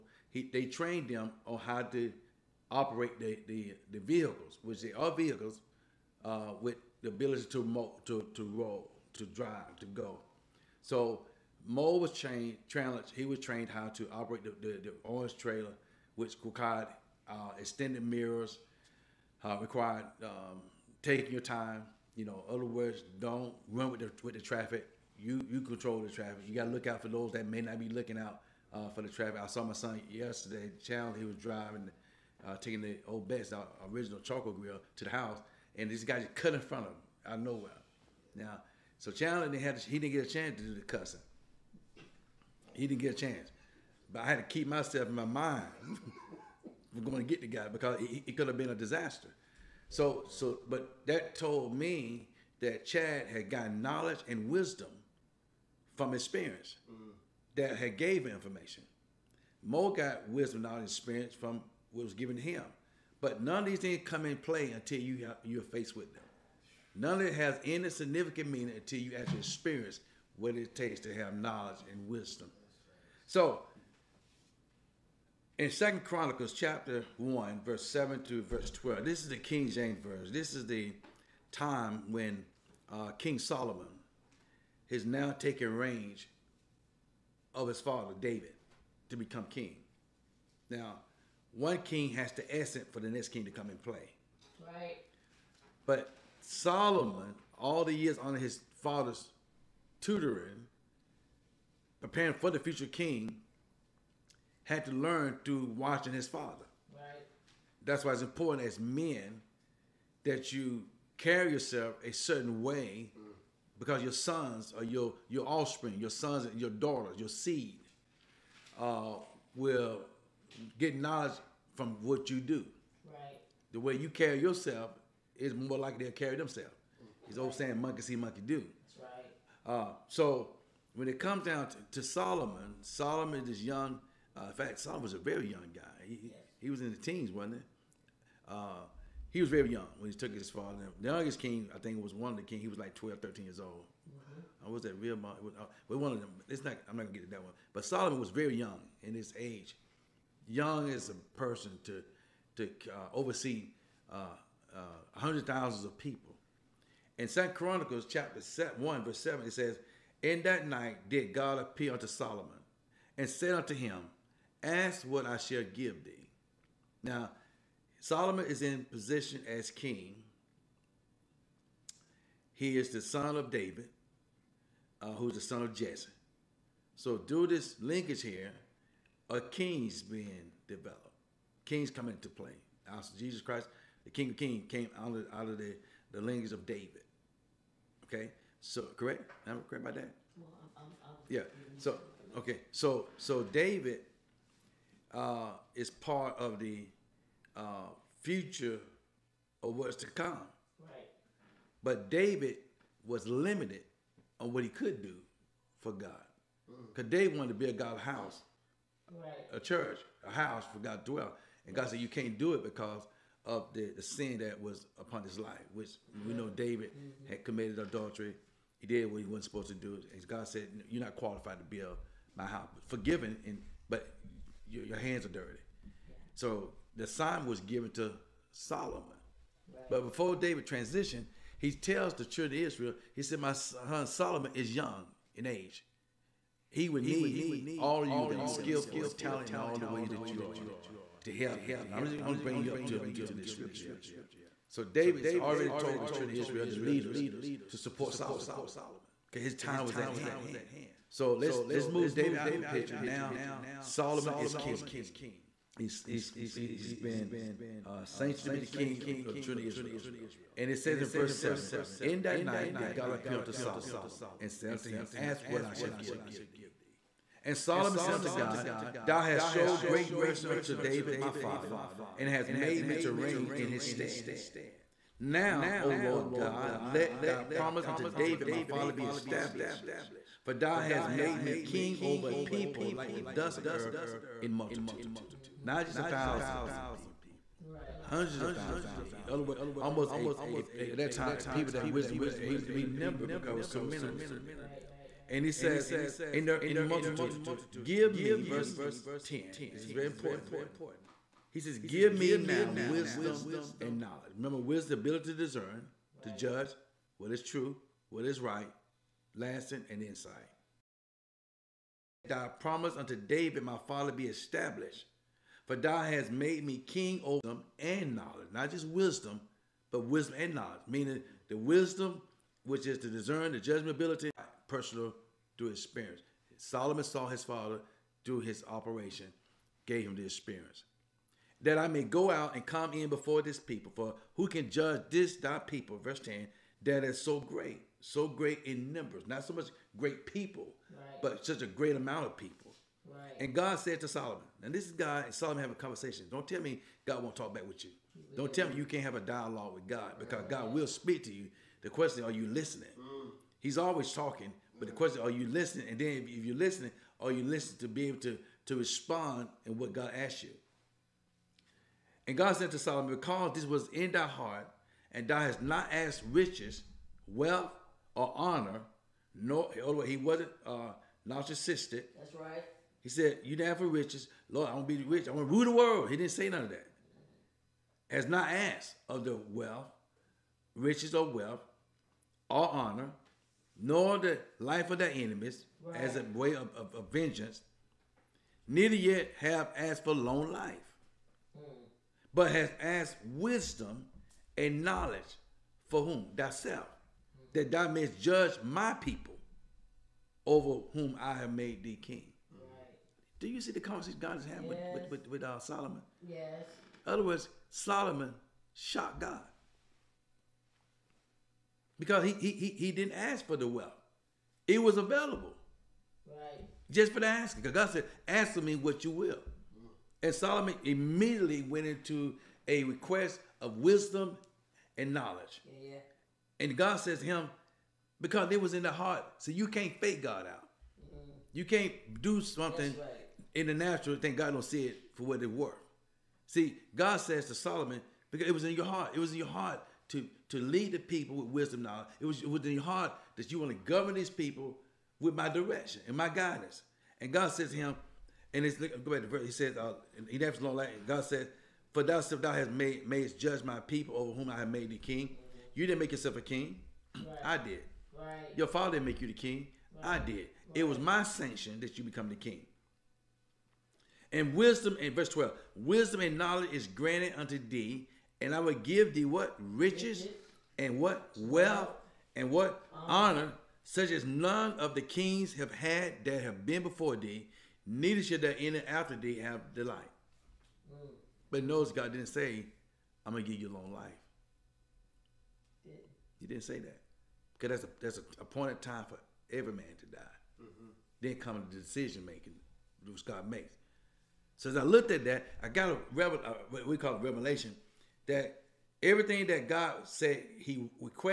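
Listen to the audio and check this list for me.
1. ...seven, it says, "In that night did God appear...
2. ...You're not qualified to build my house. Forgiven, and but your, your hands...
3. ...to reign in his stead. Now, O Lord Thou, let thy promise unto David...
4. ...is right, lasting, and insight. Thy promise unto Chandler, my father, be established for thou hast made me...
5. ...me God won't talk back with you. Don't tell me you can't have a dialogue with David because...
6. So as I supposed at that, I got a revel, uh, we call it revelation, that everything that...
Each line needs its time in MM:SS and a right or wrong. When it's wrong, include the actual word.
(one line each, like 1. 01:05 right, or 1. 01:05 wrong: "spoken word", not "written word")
1. 02:39 right
2. 03:40 right
3. 04:32 wrong: "God", not "Thou"
4. 05:08 wrong: "David", not "Chandler"
5. 05:46 wrong: "God", not "David"
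6. 08:14 wrong: "looked", not "supposed".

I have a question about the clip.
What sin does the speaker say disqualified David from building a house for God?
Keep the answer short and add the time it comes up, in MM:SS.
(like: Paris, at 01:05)
Adultery, at 03:37.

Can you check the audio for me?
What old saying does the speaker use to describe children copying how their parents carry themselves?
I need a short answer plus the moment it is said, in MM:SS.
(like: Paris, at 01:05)
Monkey see, monkey do, at 02:07.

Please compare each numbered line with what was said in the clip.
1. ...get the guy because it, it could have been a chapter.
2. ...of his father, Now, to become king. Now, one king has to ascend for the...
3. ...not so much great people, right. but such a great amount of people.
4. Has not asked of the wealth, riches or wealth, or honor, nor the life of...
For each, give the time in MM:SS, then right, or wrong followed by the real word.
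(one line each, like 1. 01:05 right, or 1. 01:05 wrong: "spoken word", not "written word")
1. 00:47 wrong: "disaster", not "chapter"
2. 01:27 wrong: "David", not "Now"
3. 05:39 right
4. 06:18 right.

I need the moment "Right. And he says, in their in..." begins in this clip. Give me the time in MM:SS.
04:54.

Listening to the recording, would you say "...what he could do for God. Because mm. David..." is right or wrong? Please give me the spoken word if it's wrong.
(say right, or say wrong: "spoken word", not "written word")
right.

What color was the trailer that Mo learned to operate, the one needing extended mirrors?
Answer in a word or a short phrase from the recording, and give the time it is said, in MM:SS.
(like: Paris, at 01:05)
Orange, at 00:15.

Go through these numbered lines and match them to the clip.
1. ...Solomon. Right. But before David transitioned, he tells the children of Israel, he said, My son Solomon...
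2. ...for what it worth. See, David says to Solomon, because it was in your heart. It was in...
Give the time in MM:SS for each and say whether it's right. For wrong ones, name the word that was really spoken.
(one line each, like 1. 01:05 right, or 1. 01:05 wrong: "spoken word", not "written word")
1. 03:48 right
2. 07:15 wrong: "God", not "David".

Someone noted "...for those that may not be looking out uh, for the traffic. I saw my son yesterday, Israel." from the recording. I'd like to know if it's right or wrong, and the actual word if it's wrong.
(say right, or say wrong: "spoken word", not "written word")
wrong: "Chandler", not "Israel".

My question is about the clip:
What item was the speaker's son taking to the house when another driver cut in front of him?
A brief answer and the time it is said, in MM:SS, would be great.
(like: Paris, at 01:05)
Charcoal grill, at 00:34.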